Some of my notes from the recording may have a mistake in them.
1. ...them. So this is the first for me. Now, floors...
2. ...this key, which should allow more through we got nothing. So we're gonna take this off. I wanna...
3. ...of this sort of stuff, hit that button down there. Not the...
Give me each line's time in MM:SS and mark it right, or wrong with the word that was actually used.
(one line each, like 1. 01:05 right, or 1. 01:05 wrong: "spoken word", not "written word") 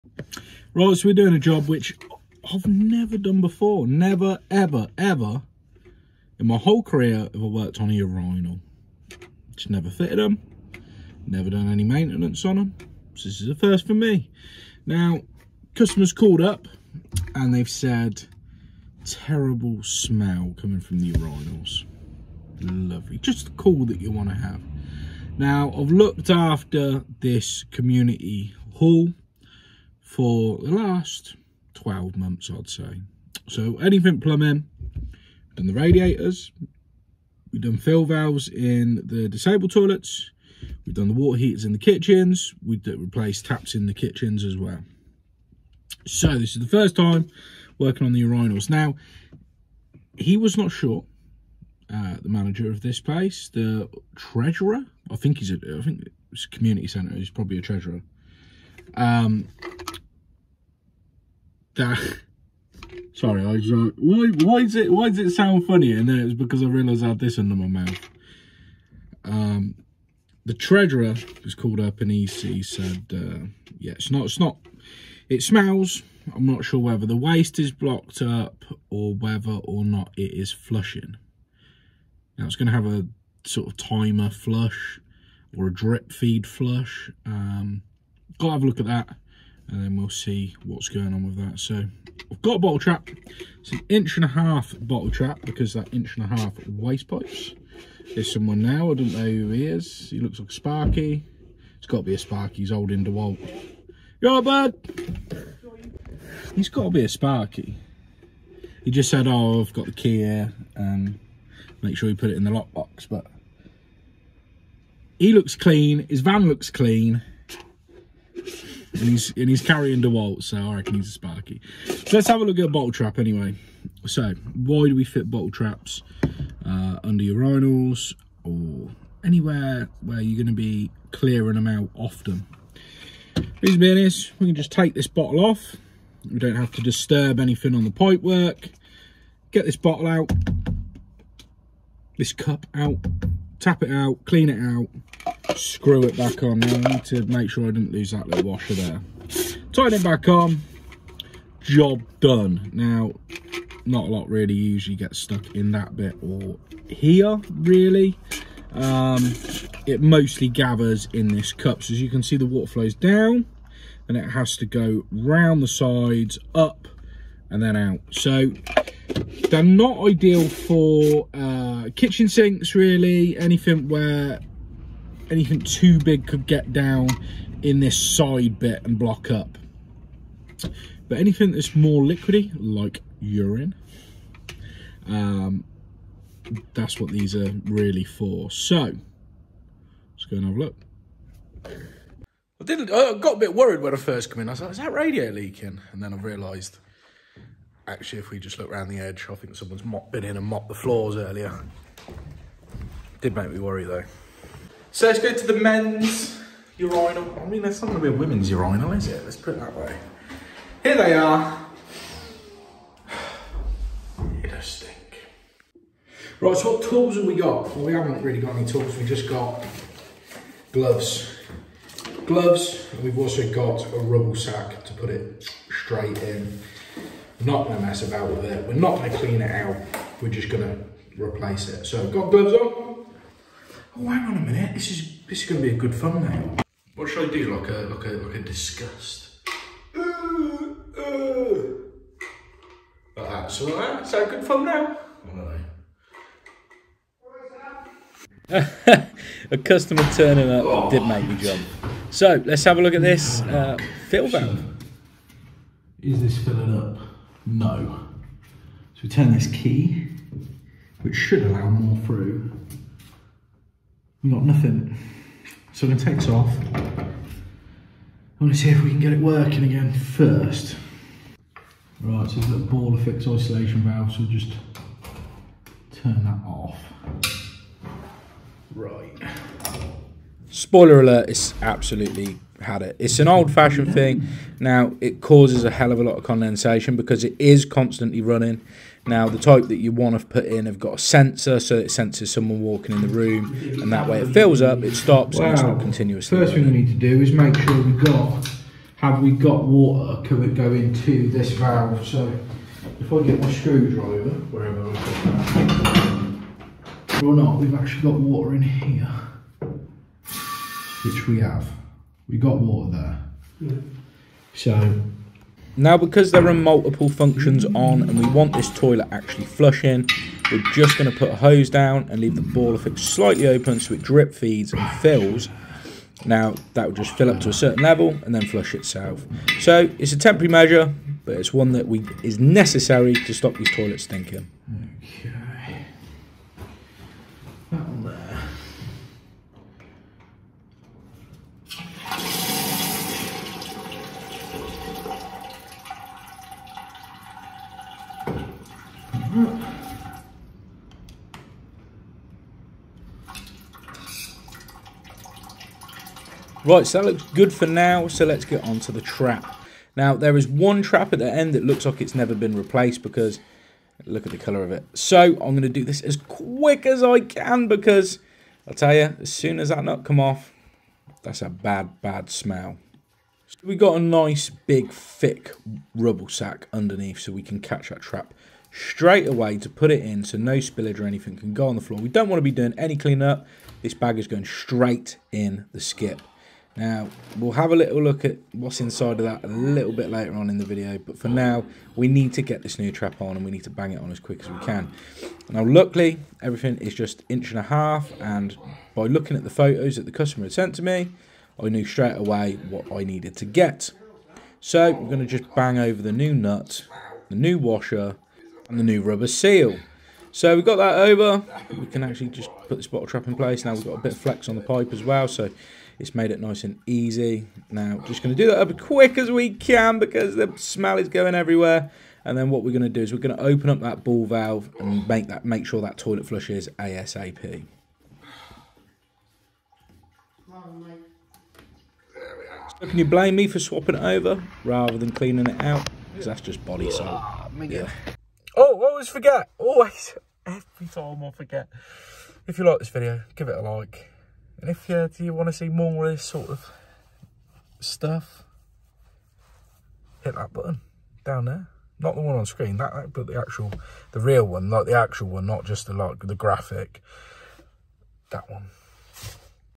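1. 00:12 wrong: "customers", not "floors"
2. 04:19 right
3. 07:26 right.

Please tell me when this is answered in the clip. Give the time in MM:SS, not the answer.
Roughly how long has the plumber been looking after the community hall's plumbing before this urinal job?
00:31.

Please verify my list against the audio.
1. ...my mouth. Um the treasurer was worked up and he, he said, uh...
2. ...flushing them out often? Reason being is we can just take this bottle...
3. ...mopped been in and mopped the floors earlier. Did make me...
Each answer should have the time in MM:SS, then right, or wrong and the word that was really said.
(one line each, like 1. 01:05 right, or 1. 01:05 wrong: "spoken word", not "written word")
1. 01:07 wrong: "called", not "worked"
2. 02:11 wrong: "clearing", not "flushing"
3. 03:19 right.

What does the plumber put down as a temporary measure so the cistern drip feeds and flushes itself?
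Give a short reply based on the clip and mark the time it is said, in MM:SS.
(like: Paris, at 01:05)
A hose, at 05:21.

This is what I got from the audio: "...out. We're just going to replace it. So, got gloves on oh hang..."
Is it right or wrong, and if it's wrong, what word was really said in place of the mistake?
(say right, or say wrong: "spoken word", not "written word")
right.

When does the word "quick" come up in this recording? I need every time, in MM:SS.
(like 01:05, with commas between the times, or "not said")
06:06, 06:34, 06:58.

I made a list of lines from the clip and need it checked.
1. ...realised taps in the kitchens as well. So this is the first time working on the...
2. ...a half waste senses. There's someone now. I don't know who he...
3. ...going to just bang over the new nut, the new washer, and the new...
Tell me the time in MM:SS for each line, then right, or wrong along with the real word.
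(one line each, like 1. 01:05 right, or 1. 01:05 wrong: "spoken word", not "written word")
1. 00:42 wrong: "replaced", not "realised"
2. 01:36 wrong: "pipes", not "senses"
3. 06:45 right.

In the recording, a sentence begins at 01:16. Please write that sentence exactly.
I'm not sure whether the waste is blocked up or whether or not it is flushing.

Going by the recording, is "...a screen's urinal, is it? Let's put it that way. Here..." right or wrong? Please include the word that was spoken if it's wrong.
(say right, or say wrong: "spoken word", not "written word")
wrong: "women", not "screen".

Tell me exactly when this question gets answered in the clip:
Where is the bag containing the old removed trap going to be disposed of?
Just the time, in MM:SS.
06:25.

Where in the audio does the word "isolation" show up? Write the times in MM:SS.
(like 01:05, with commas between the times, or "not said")
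04:33.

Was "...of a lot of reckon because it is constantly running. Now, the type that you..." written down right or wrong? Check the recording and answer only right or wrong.
wrong.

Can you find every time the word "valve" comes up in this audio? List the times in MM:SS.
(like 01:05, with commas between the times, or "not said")
00:38, 04:14, 04:33, 05:01, 07:04.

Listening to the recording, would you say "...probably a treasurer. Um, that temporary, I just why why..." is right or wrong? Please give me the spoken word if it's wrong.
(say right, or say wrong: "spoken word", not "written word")
wrong: "sorry", not "temporary".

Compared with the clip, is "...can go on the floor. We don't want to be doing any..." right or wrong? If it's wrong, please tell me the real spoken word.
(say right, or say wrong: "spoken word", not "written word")
right.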